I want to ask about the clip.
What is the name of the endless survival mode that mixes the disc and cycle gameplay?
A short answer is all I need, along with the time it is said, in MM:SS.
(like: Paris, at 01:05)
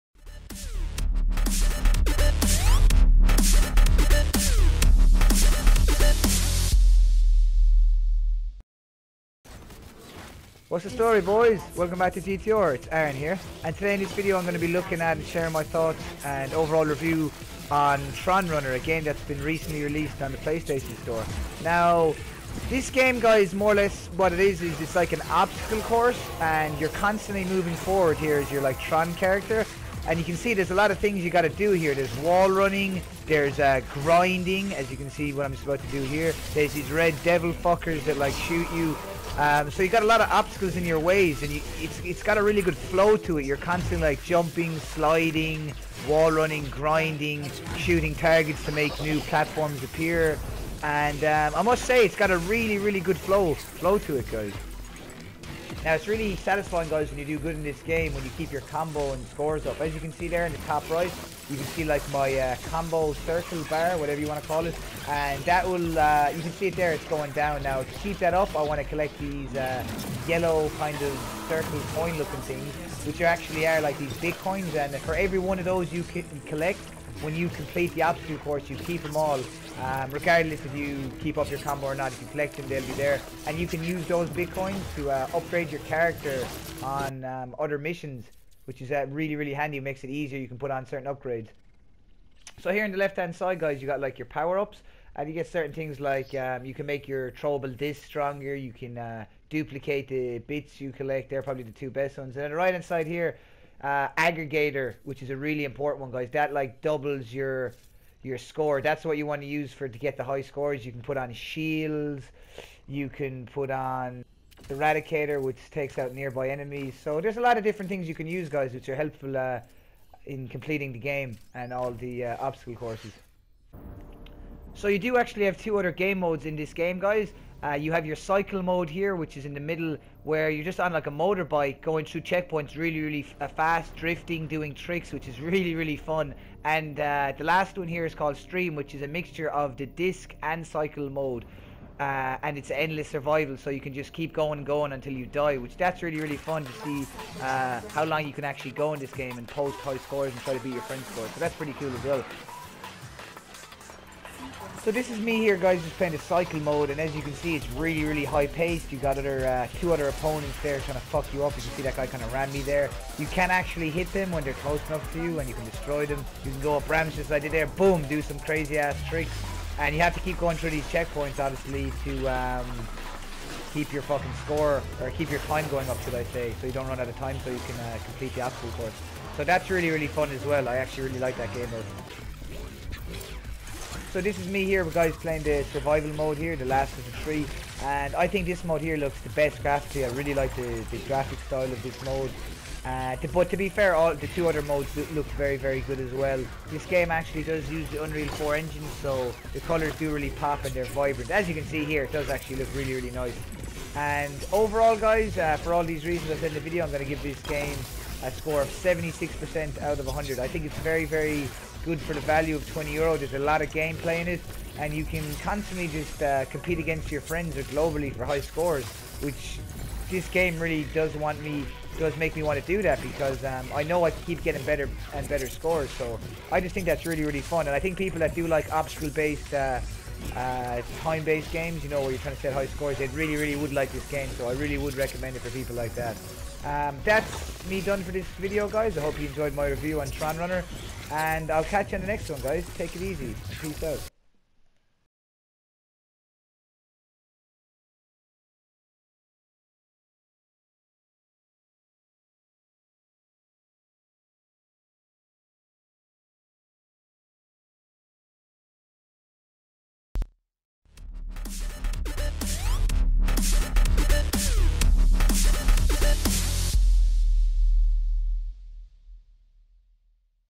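Stream, at 02:18.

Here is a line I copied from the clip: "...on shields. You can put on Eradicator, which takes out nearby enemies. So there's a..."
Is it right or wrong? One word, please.
right.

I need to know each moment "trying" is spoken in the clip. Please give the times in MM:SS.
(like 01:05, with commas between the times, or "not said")
02:40, 03:52.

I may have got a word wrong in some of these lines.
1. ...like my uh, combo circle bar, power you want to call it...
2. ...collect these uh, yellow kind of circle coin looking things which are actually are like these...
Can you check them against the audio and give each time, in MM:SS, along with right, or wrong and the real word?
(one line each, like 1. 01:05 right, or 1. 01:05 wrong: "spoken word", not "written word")
1. 01:01 wrong: "whatever", not "power"
2. 01:08 right.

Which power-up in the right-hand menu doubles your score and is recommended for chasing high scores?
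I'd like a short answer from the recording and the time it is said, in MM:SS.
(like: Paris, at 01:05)
Aggregator, at 01:44.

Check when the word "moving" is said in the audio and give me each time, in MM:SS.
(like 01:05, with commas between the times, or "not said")
00:27.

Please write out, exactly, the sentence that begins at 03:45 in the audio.
So I just think that's really, really fun.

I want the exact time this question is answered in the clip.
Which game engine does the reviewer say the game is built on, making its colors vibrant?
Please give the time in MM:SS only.
03:18.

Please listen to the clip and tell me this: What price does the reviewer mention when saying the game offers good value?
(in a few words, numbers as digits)
20 euro.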